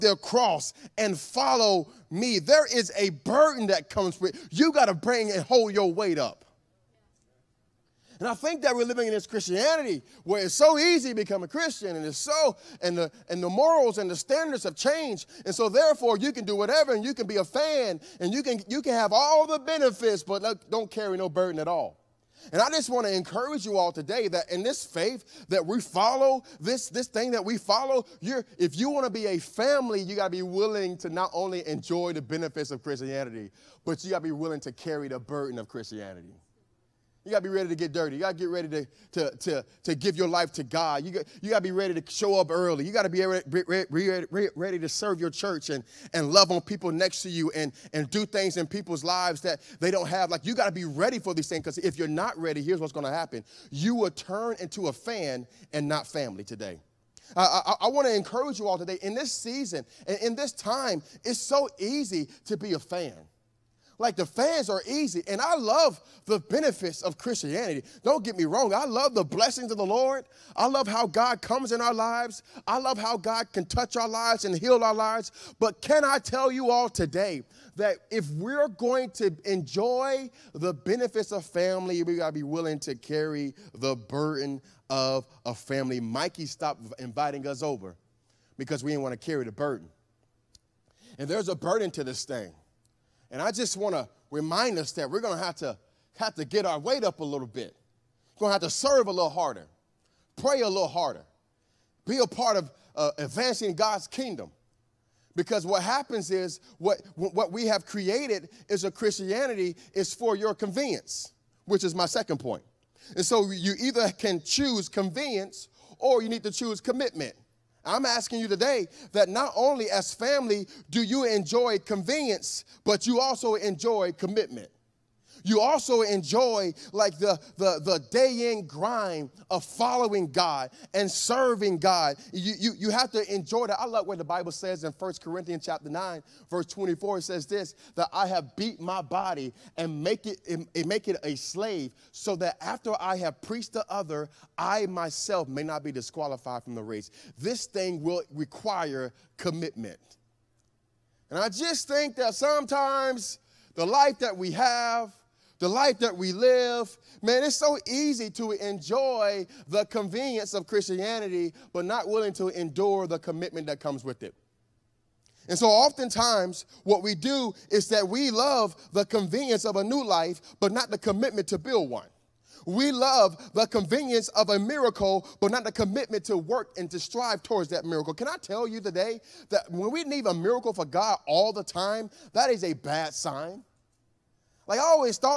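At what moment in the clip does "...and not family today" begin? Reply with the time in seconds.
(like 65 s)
55 s.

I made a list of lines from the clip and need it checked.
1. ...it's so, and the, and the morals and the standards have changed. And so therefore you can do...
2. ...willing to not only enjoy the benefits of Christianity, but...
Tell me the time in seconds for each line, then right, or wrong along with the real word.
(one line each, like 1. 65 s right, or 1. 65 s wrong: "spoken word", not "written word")
1. 12 s right
2. 30 s right.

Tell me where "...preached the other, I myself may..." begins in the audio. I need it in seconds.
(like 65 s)
143 s.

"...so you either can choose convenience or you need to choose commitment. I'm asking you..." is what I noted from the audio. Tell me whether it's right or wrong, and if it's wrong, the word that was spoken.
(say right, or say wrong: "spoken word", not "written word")
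right.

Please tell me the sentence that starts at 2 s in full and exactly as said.
There is a burden that comes with you.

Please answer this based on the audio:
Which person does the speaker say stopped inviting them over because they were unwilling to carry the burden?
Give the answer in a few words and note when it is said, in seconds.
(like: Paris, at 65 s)
Mikey, at 86 s.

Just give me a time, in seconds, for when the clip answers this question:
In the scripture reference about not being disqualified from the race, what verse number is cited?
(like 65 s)
136 s.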